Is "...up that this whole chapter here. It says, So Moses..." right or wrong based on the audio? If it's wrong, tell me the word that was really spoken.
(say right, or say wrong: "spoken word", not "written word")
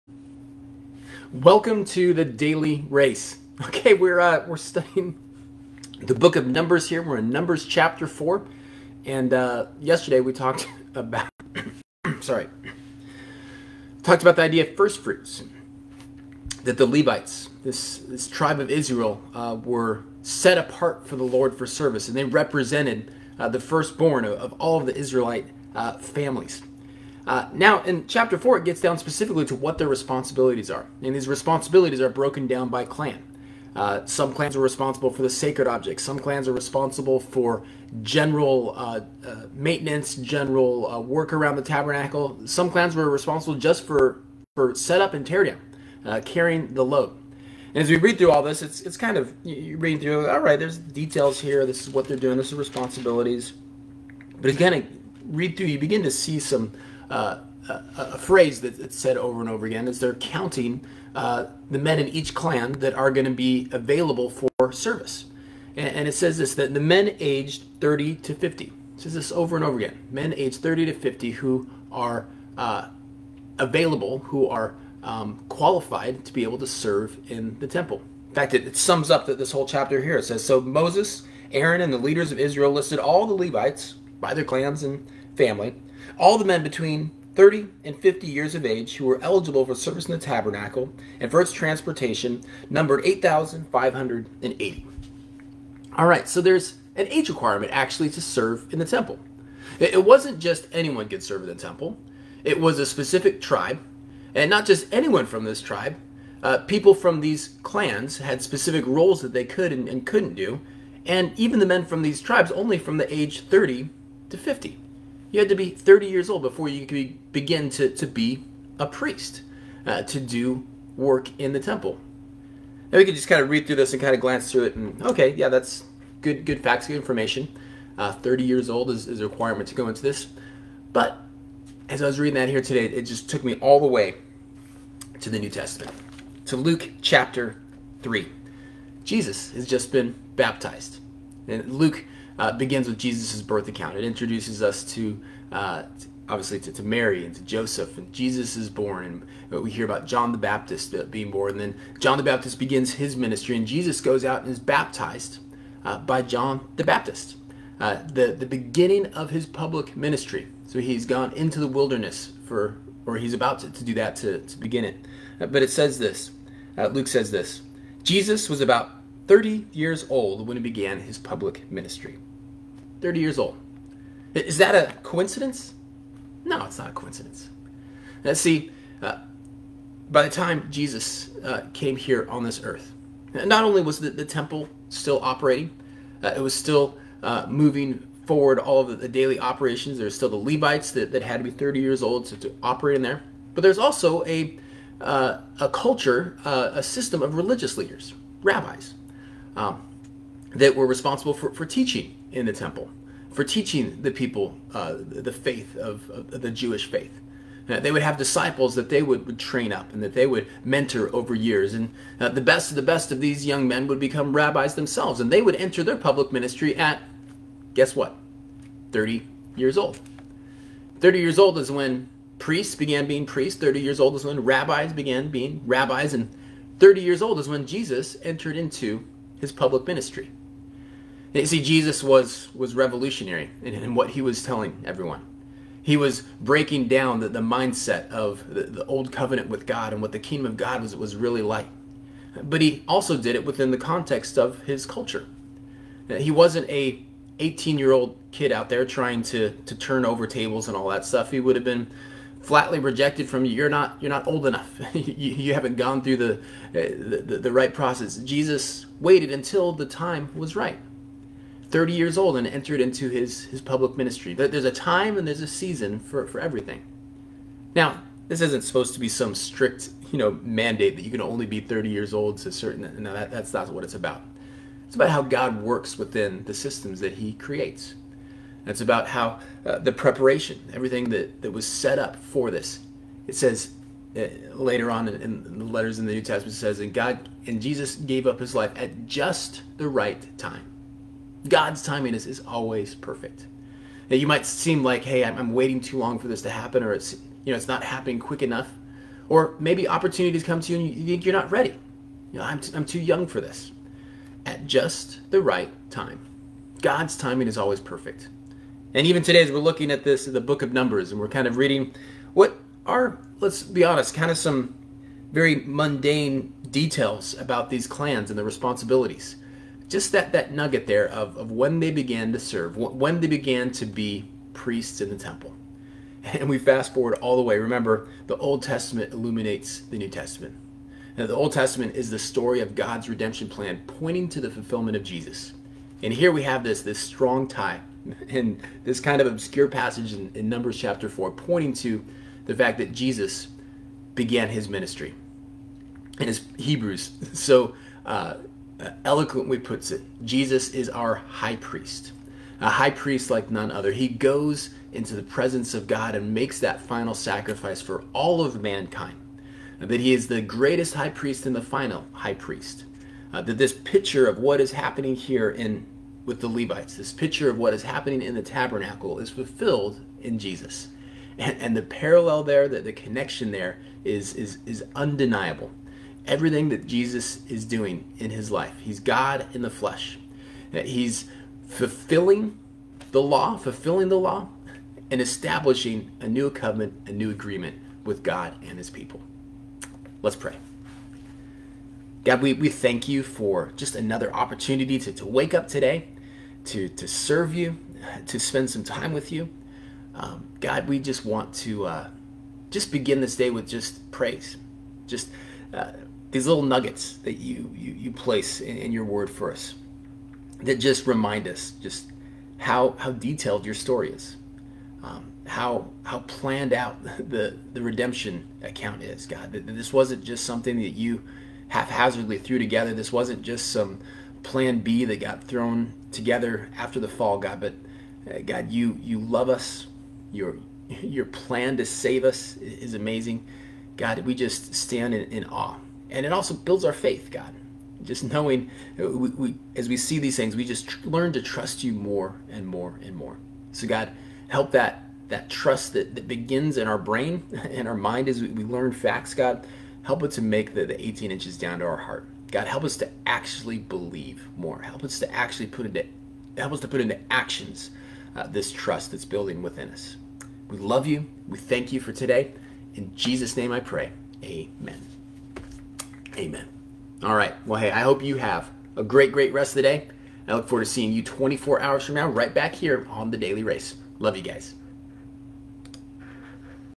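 right.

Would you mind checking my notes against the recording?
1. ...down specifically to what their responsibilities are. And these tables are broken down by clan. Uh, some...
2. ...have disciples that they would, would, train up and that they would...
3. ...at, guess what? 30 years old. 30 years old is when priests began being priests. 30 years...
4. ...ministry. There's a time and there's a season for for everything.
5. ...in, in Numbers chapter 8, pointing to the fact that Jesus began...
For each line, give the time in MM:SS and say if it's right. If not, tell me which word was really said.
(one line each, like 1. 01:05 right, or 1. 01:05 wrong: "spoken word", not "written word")
1. 00:28 wrong: "responsibilities", not "tables"
2. 03:28 right
3. 03:36 right
4. 04:23 right
5. 05:40 wrong: "4", not "8".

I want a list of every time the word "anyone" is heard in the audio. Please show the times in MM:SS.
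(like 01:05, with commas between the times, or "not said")
01:40, 01:44.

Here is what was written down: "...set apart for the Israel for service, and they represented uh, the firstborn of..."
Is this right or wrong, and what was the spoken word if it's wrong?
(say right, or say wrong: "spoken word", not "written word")
wrong: "Lord", not "Israel".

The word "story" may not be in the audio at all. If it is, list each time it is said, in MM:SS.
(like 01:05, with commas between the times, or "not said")
05:32, 06:53.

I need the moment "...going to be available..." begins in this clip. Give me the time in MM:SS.
01:03.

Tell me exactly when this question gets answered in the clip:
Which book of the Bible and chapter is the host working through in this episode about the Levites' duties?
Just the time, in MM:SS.
00:07.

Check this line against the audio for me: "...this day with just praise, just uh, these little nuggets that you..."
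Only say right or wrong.
right.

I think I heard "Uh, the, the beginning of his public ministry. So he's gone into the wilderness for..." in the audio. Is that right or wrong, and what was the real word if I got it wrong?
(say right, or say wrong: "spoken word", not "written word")
right.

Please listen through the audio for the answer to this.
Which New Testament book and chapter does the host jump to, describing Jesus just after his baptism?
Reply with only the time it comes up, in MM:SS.
02:16.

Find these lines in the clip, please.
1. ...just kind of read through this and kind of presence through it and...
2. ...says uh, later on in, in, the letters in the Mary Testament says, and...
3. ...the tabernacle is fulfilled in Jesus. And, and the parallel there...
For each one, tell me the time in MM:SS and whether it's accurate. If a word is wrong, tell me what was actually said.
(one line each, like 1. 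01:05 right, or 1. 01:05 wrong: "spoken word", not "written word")
1. 02:03 wrong: "glance", not "presence"
2. 04:43 wrong: "New", not "Mary"
3. 06:08 right.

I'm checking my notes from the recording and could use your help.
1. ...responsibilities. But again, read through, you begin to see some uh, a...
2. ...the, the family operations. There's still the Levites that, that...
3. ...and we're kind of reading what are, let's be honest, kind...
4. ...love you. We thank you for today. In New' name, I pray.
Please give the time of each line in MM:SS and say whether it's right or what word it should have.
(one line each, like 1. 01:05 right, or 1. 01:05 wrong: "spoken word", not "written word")
1. 00:52 right
2. 03:08 wrong: "daily", not "family"
3. 05:11 right
4. 07:40 wrong: "Jesus", not "New".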